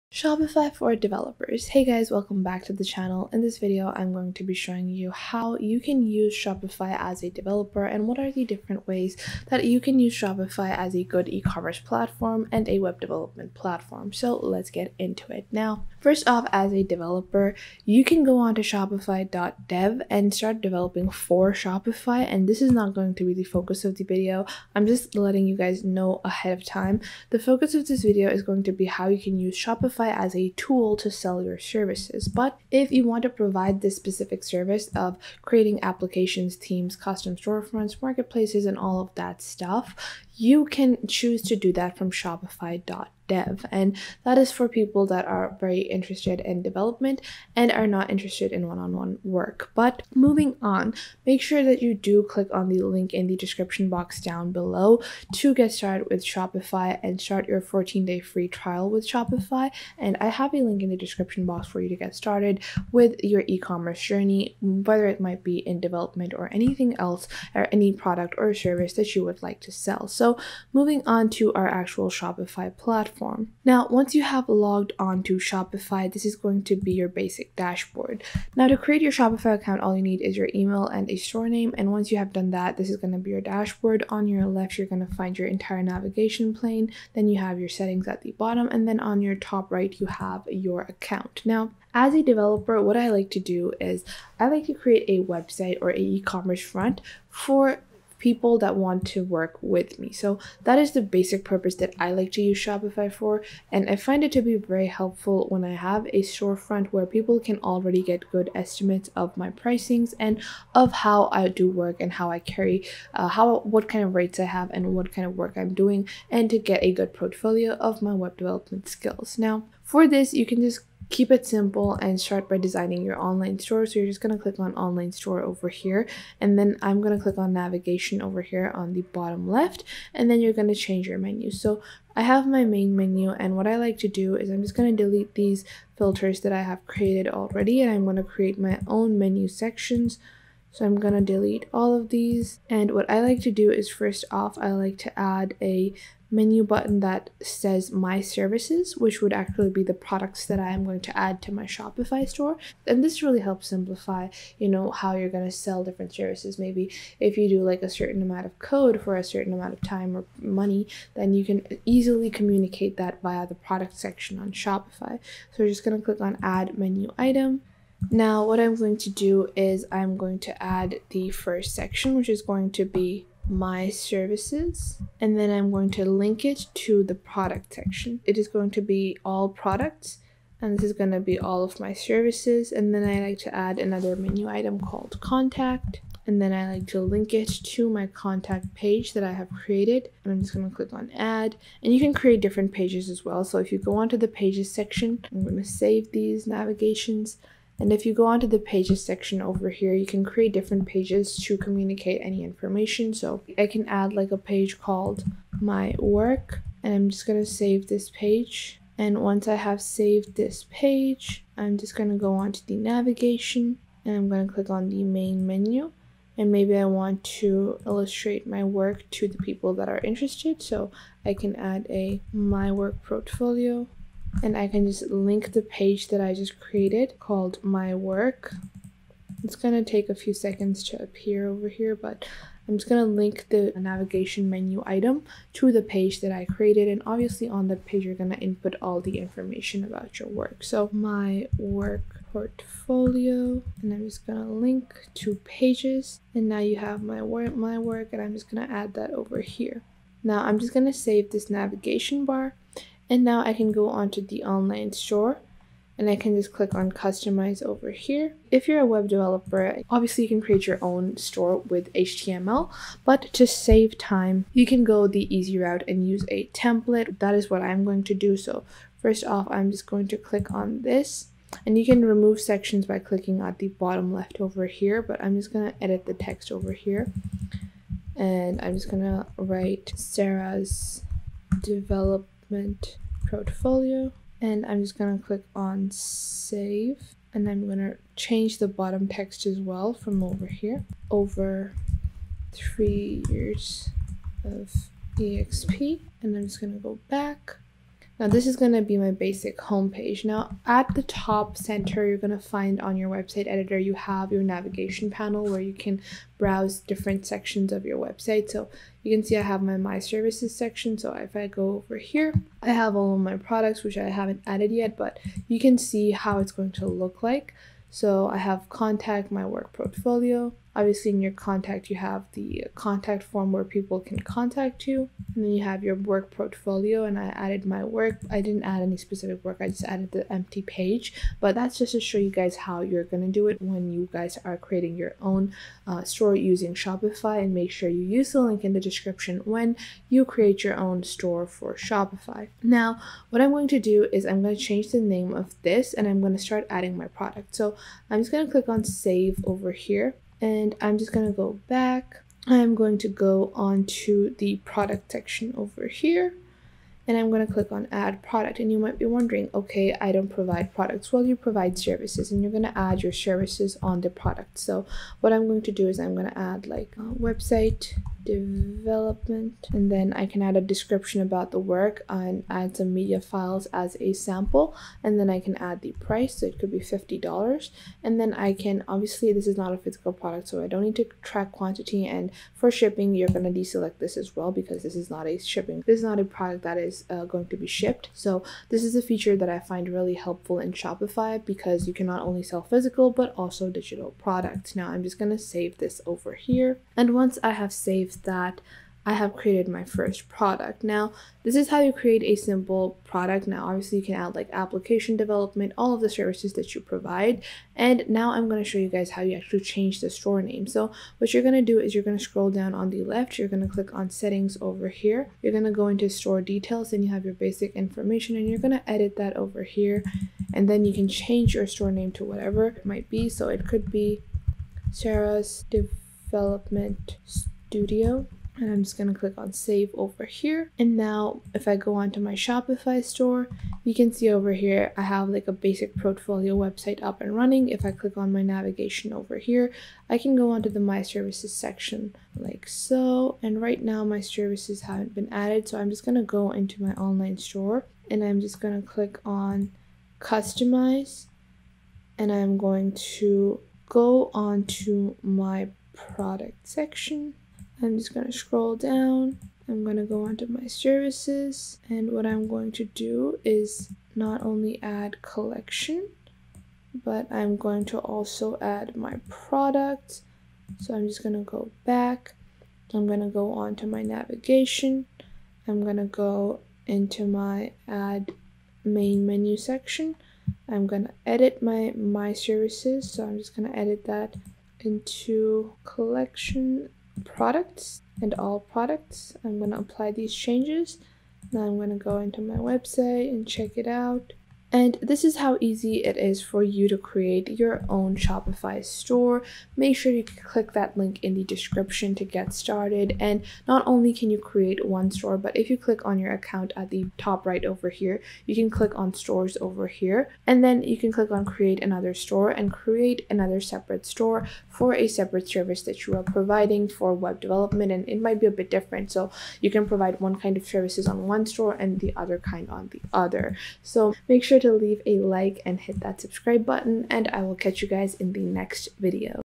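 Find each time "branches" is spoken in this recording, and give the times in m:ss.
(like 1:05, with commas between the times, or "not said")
not said.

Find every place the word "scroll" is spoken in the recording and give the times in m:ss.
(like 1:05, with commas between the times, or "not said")
6:52, 7:38.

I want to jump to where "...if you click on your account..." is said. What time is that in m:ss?
8:25.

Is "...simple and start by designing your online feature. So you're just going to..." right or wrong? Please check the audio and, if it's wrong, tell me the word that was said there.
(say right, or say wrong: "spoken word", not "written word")
wrong: "store", not "feature".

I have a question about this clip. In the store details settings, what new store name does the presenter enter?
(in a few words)
Sarah's development store Studio.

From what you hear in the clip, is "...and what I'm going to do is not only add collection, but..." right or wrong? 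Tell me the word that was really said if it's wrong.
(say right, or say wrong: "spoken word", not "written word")
right.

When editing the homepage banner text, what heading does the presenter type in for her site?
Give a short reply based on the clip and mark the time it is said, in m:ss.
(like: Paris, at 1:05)
Sarah's develop portfolio, at 4:39.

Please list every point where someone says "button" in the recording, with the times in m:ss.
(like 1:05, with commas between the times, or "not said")
2:26, 8:46.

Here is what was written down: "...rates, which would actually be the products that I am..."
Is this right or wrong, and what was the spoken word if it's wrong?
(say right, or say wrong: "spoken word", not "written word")
wrong: "services", not "rates".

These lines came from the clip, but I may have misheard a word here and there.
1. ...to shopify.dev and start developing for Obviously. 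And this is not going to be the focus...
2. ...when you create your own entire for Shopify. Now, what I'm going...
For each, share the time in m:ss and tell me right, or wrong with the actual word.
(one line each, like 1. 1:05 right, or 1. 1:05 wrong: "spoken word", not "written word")
1. 0:18 wrong: "Shopify", not "Obviously"
2. 5:39 wrong: "store", not "entire".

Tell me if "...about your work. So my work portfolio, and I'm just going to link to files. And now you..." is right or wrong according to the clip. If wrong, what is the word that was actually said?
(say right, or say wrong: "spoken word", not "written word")
wrong: "pages", not "files".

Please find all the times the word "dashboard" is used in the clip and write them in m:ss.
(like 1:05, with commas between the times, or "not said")
1:17, 1:23.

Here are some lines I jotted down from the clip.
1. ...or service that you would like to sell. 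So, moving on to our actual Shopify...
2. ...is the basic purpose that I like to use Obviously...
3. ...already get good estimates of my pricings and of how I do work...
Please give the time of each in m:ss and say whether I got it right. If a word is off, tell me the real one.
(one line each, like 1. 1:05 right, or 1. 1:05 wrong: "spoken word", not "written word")
1. 1:08 right
2. 1:40 wrong: "Shopify", not "Obviously"
3. 1:47 right.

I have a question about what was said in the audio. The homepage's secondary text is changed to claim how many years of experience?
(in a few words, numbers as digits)
3.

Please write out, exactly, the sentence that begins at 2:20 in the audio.
So I'm going to delete all of these.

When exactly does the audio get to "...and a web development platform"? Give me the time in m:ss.
0:12.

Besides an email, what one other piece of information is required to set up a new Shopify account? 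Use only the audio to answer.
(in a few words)
A store name.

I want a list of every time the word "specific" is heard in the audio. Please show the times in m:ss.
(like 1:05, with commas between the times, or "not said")
0:33, 5:28.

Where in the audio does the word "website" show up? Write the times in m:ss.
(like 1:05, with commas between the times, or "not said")
1:35, 5:03, 5:07, 6:07, 7:16, 8:12.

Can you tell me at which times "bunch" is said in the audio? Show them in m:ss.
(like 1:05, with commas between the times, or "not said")
not said.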